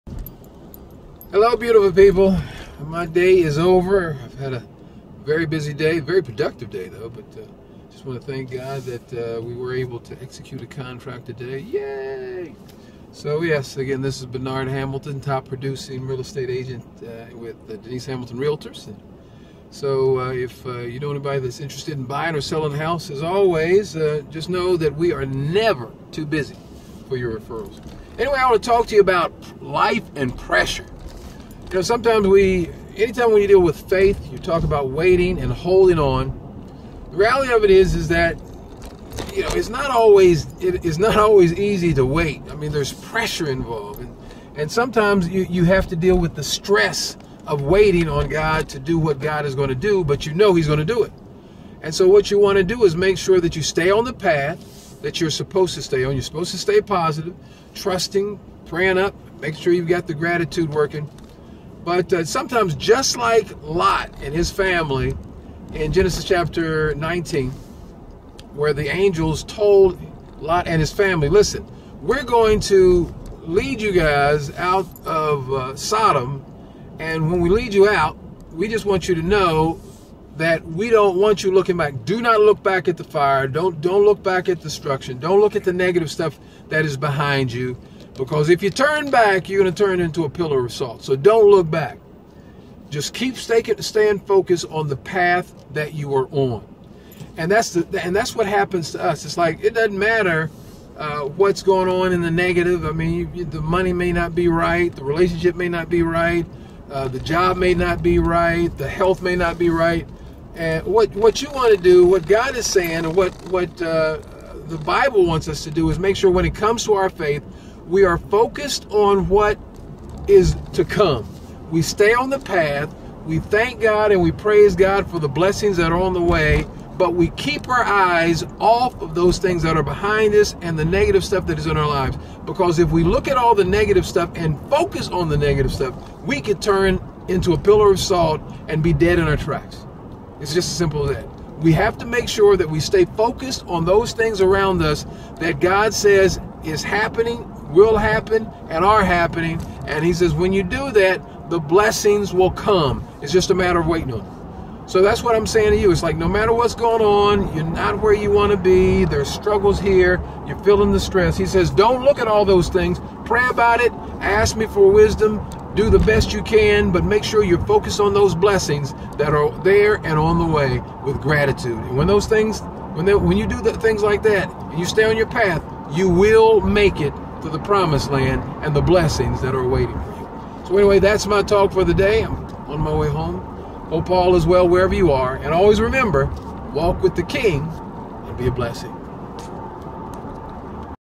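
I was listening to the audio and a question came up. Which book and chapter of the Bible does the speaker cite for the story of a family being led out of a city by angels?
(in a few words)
Genesis chapter 19.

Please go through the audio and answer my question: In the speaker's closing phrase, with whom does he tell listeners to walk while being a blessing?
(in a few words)
the King.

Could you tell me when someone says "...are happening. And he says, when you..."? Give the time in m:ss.
2:28.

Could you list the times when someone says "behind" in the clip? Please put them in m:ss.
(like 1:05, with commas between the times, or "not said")
1:26, 2:09.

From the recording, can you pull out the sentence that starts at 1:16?
And when we lead you out, we just want you to know that we don't want you looking back.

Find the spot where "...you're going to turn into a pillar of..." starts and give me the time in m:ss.
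1:29.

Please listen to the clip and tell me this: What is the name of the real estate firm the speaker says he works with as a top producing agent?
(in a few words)
Denise Hamilton Realtors.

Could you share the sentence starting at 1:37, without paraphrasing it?
And that's the and that's what happens to us.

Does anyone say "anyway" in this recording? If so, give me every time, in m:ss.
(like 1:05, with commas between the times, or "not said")
0:28, 3:00.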